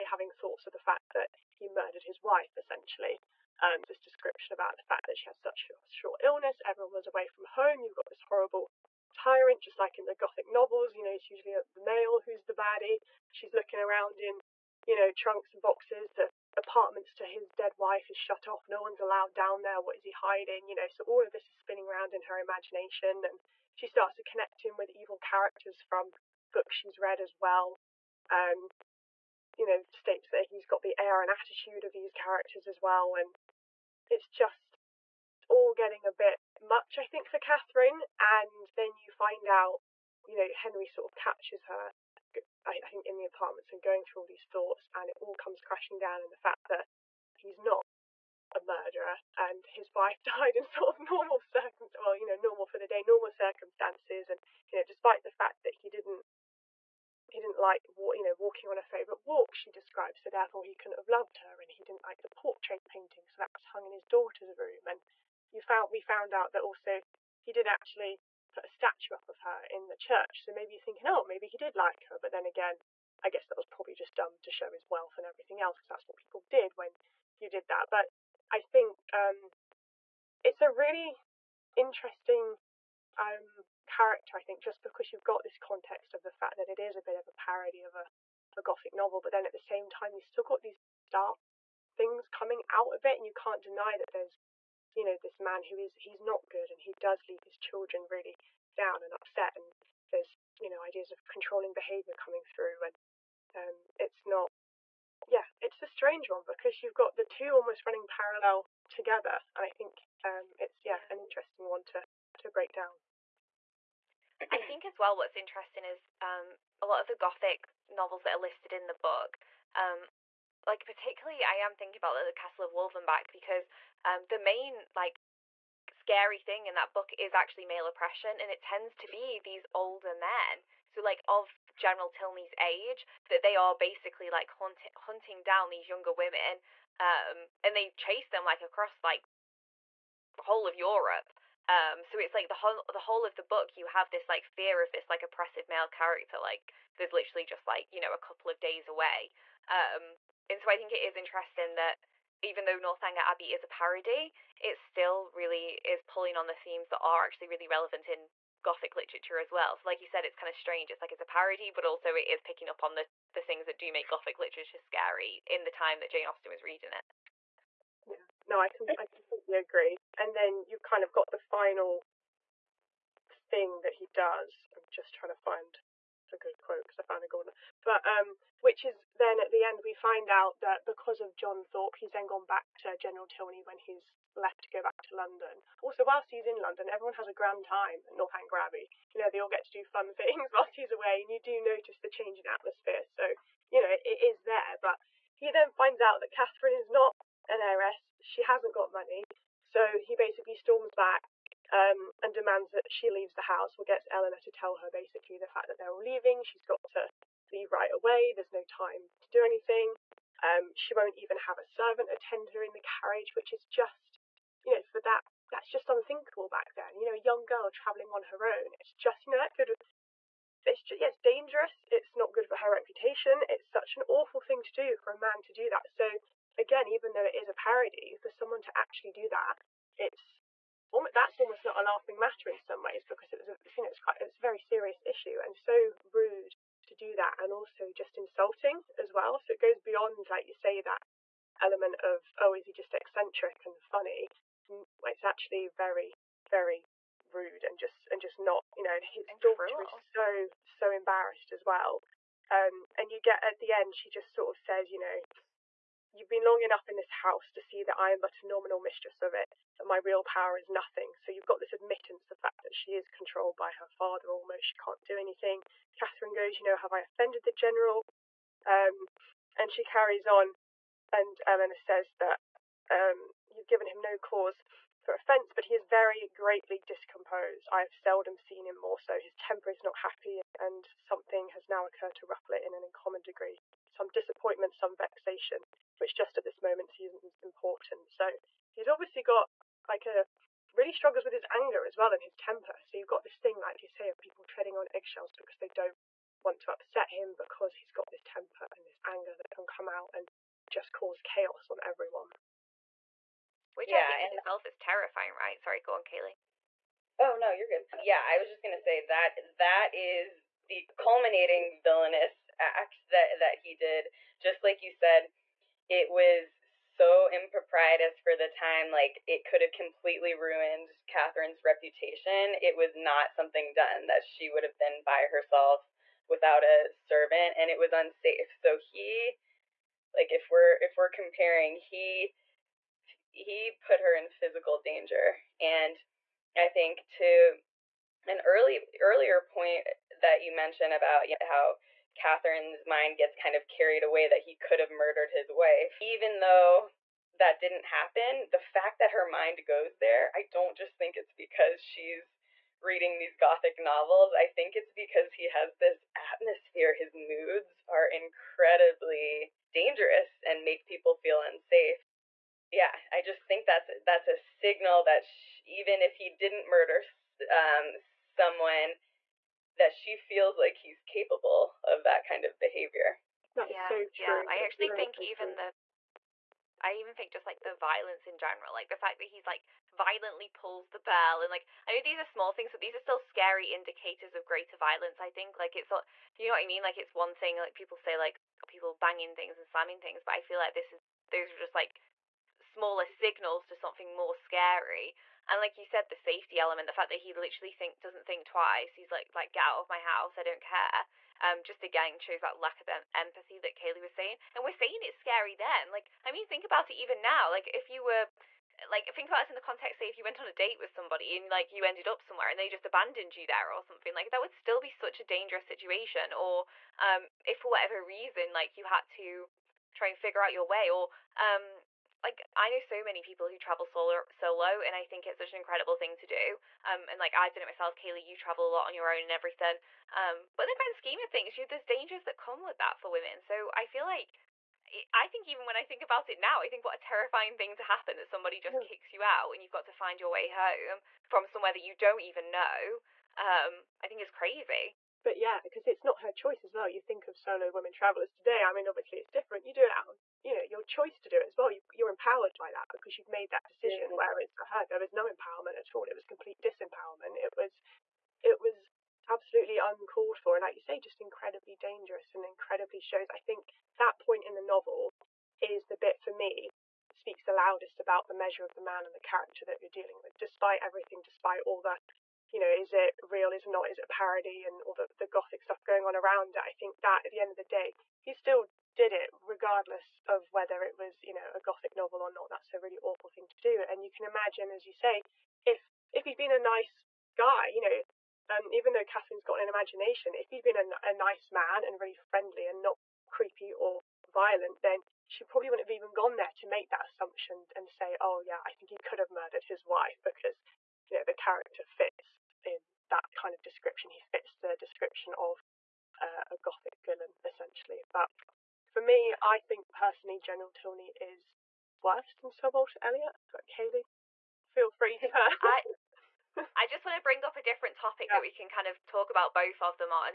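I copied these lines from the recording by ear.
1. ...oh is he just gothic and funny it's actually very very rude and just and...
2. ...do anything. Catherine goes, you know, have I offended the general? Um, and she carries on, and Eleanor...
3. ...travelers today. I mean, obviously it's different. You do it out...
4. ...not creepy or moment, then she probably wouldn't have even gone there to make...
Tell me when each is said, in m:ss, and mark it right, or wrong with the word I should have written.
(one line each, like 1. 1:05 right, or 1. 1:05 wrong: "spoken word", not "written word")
1. 4:02 wrong: "eccentric", not "gothic"
2. 4:25 right
3. 7:27 right
4. 8:12 wrong: "violent", not "moment".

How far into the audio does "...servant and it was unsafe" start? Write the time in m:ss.
5:26.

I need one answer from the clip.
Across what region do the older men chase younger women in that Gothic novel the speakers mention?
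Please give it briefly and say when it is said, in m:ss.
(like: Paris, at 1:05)
Europe, at 2:20.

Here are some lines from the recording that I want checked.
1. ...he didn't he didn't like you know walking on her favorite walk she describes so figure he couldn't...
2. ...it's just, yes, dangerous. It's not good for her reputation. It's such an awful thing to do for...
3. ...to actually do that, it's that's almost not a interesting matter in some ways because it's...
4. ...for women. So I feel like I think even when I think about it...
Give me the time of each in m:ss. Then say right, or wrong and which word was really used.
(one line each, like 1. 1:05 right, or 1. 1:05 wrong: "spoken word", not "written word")
1. 0:55 wrong: "therefore", not "figure"
2. 3:40 right
3. 3:48 wrong: "laughing", not "interesting"
4. 7:12 right.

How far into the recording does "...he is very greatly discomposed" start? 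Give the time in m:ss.
4:35.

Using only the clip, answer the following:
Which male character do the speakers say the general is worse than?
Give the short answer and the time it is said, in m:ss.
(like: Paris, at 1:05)
Sir Walter Elliot, at 8:32.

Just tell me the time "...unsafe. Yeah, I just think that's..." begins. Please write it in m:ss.
6:01.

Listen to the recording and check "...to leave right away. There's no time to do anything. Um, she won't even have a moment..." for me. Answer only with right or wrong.
wrong.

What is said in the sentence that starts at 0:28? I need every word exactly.
Um, you know, states that he's got the air and attitude of these characters as well.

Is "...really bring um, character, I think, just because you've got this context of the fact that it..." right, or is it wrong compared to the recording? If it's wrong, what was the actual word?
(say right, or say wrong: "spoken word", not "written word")
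wrong: "interesting", not "bring".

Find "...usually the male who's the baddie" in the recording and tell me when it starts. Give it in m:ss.
0:11.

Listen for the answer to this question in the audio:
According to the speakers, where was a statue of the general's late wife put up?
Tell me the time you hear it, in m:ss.
1:09.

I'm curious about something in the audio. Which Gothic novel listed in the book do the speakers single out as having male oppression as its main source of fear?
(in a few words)
The Castle of Wolfenbach.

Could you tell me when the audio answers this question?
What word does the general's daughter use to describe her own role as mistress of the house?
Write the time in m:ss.
4:18.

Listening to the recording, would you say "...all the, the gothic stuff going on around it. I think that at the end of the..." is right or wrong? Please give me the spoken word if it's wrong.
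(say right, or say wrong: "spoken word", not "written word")
right.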